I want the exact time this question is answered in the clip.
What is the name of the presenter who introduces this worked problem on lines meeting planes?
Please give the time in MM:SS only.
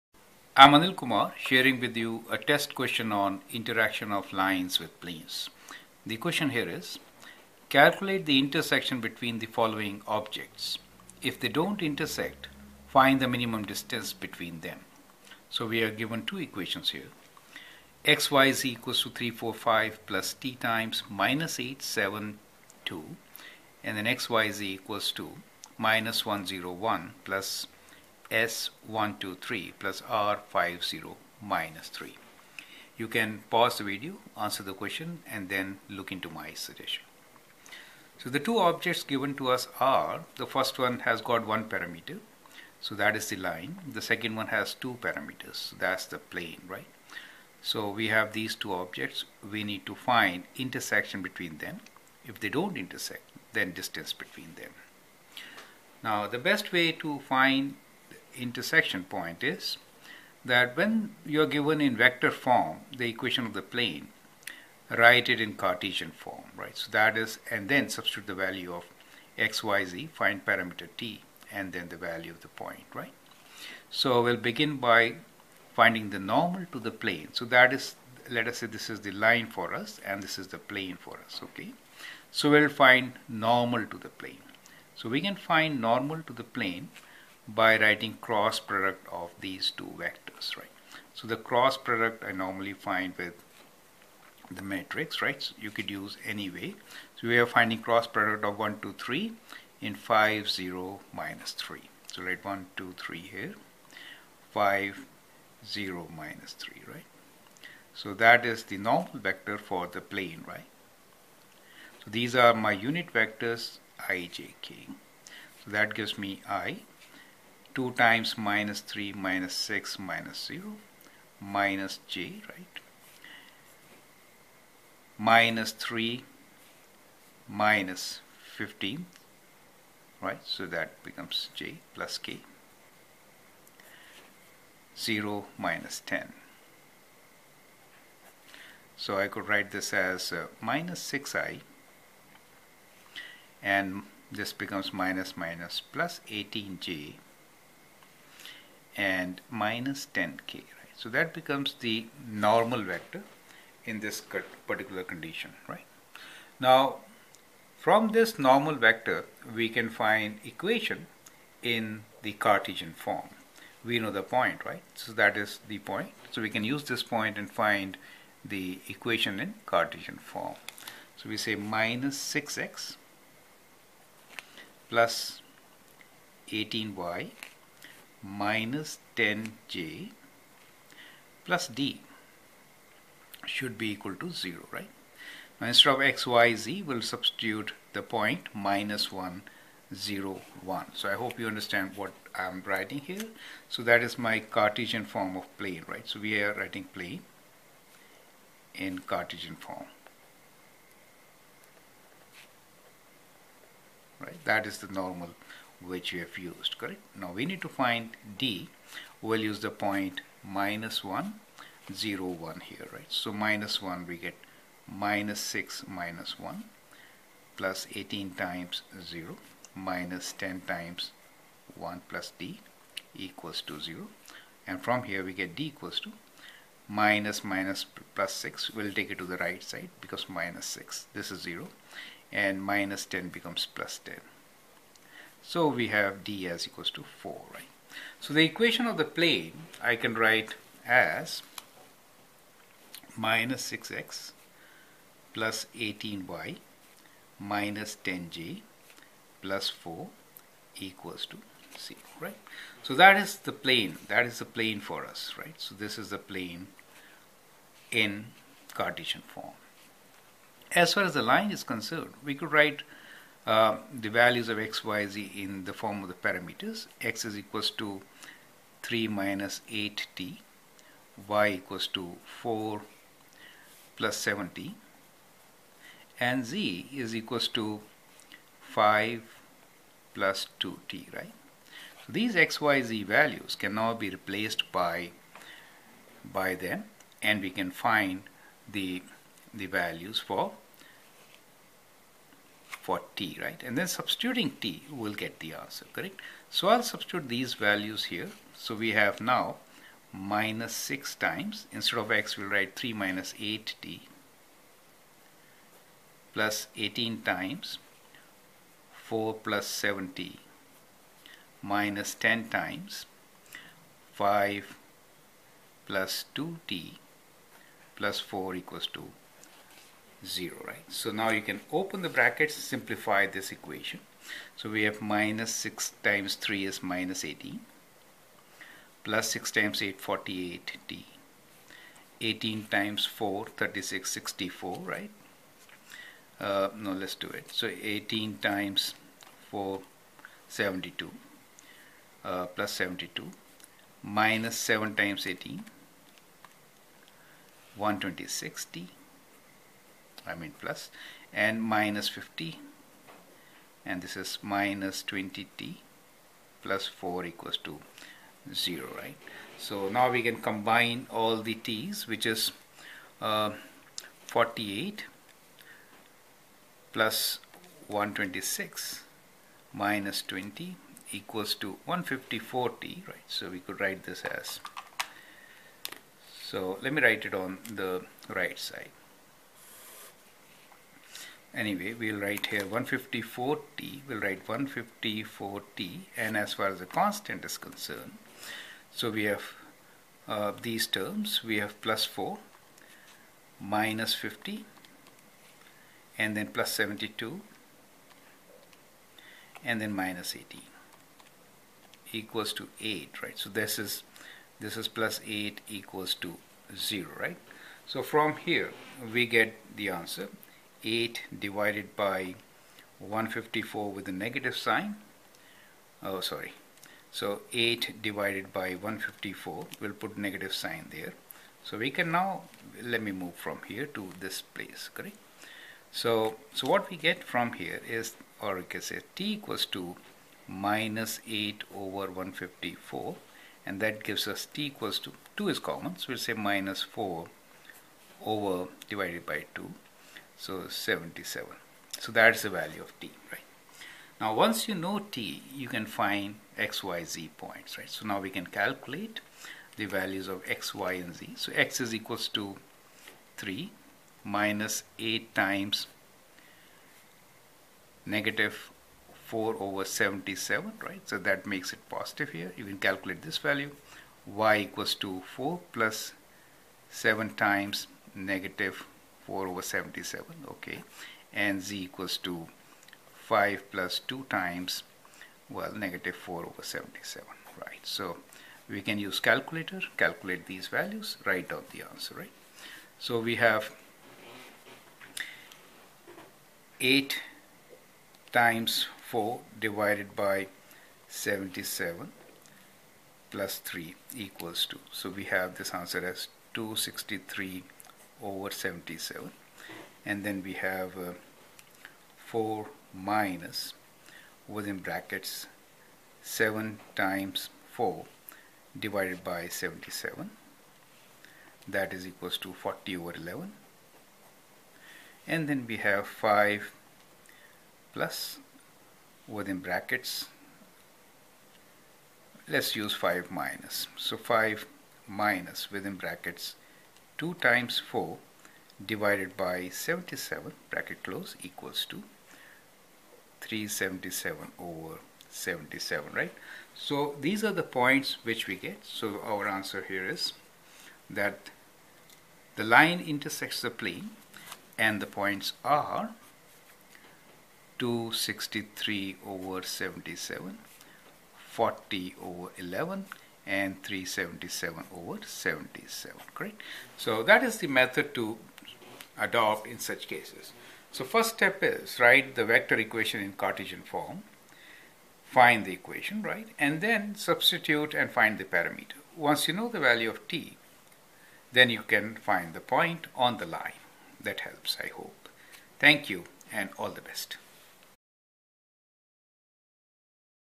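00:00.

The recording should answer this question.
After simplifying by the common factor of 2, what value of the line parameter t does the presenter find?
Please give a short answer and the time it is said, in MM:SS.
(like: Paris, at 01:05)
-4/77, at 07:16.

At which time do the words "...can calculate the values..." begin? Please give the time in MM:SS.
07:28.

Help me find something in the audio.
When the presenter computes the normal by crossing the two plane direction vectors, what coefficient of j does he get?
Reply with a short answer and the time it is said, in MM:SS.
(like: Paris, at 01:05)
18, at 02:25.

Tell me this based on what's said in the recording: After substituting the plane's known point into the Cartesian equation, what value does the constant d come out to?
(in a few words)
4.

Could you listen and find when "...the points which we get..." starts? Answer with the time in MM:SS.
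08:57.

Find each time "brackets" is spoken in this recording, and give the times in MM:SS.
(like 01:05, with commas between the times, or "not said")
05:22, 08:24, 08:39, 08:45, 08:50.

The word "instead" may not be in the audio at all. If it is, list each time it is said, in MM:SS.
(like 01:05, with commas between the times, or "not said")
03:05, 05:01.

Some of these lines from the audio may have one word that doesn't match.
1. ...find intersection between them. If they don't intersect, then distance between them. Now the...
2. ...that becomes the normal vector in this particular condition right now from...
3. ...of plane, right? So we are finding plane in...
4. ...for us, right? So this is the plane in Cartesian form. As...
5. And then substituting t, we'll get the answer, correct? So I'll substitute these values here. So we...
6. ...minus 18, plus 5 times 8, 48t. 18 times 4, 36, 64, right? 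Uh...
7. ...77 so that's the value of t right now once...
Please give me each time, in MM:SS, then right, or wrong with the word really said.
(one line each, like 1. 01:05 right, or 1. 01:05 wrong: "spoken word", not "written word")
1. 00:49 right
2. 02:31 right
3. 03:15 wrong: "writing", not "finding"
4. 04:14 right
5. 04:53 right
6. 05:26 wrong: "6", not "5"
7. 07:20 right.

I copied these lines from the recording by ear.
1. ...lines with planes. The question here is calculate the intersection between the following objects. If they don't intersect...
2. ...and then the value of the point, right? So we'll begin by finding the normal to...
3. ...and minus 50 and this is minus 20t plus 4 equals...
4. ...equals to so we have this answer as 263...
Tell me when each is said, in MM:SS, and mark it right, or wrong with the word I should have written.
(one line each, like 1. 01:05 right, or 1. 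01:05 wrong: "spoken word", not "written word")
1. 00:04 right
2. 01:11 right
3. 05:51 right
4. 08:14 right.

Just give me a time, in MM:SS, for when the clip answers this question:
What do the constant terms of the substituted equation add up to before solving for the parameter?
06:42.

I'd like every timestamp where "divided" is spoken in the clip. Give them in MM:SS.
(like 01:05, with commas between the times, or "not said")
06:51, 06:58, 07:18, 08:09, 08:28, 08:48.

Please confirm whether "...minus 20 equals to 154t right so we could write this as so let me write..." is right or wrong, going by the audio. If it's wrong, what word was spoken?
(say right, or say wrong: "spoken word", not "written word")
right.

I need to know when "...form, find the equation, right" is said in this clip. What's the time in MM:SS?
09:23.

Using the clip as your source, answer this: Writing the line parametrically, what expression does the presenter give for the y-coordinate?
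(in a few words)
4 + 7t.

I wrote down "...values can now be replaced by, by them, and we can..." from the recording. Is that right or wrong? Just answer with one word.
right.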